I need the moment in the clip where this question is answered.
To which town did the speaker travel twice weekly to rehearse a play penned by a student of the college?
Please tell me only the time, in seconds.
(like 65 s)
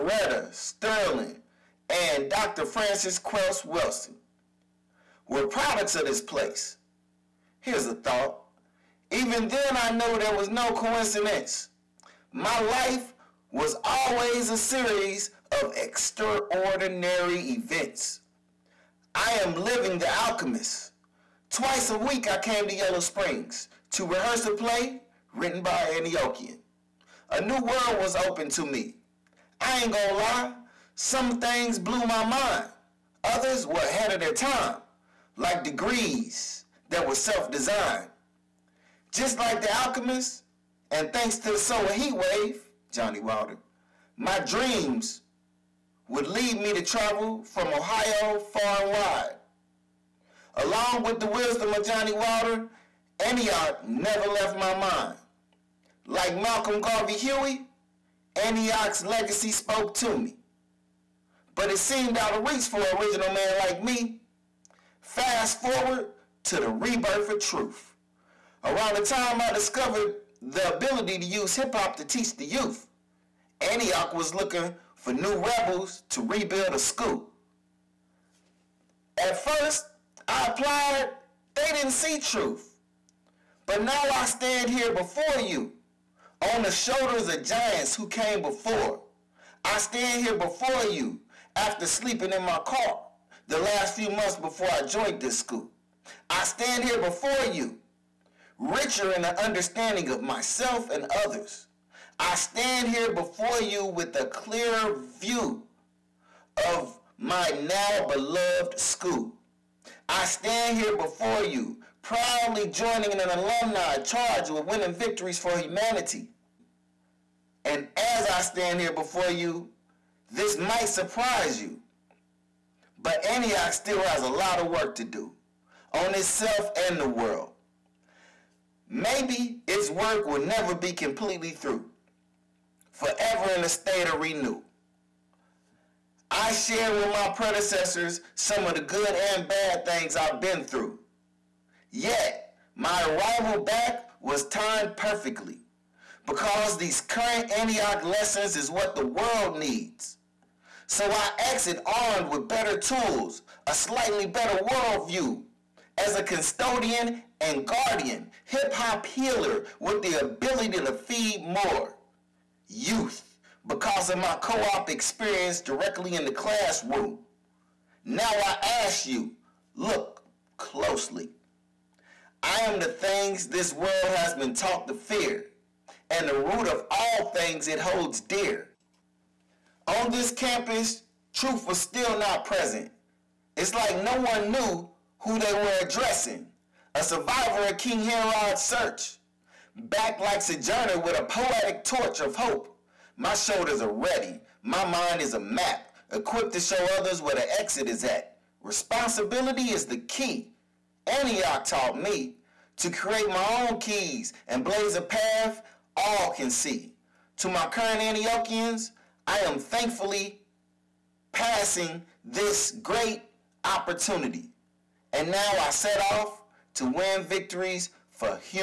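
22 s.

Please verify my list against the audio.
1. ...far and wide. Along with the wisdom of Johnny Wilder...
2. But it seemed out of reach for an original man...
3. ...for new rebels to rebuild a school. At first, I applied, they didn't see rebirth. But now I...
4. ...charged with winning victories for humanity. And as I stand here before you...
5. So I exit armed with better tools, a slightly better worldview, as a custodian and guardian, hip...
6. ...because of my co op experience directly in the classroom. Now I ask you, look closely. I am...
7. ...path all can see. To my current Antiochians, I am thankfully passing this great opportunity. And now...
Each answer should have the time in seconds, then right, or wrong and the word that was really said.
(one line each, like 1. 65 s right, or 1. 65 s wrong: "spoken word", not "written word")
1. 48 s right
2. 61 s right
3. 75 s wrong: "truth", not "rebirth"
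4. 113 s right
5. 150 s right
6. 163 s right
7. 205 s right.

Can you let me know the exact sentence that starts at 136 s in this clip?
I share with my predecessors some of the good and bad things I've been through.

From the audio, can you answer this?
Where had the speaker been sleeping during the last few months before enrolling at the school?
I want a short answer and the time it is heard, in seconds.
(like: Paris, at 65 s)
in my car, at 92 s.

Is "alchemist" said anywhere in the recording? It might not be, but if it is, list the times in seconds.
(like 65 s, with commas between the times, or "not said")
20 s, 39 s.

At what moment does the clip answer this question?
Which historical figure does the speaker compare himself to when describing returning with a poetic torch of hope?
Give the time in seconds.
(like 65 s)
190 s.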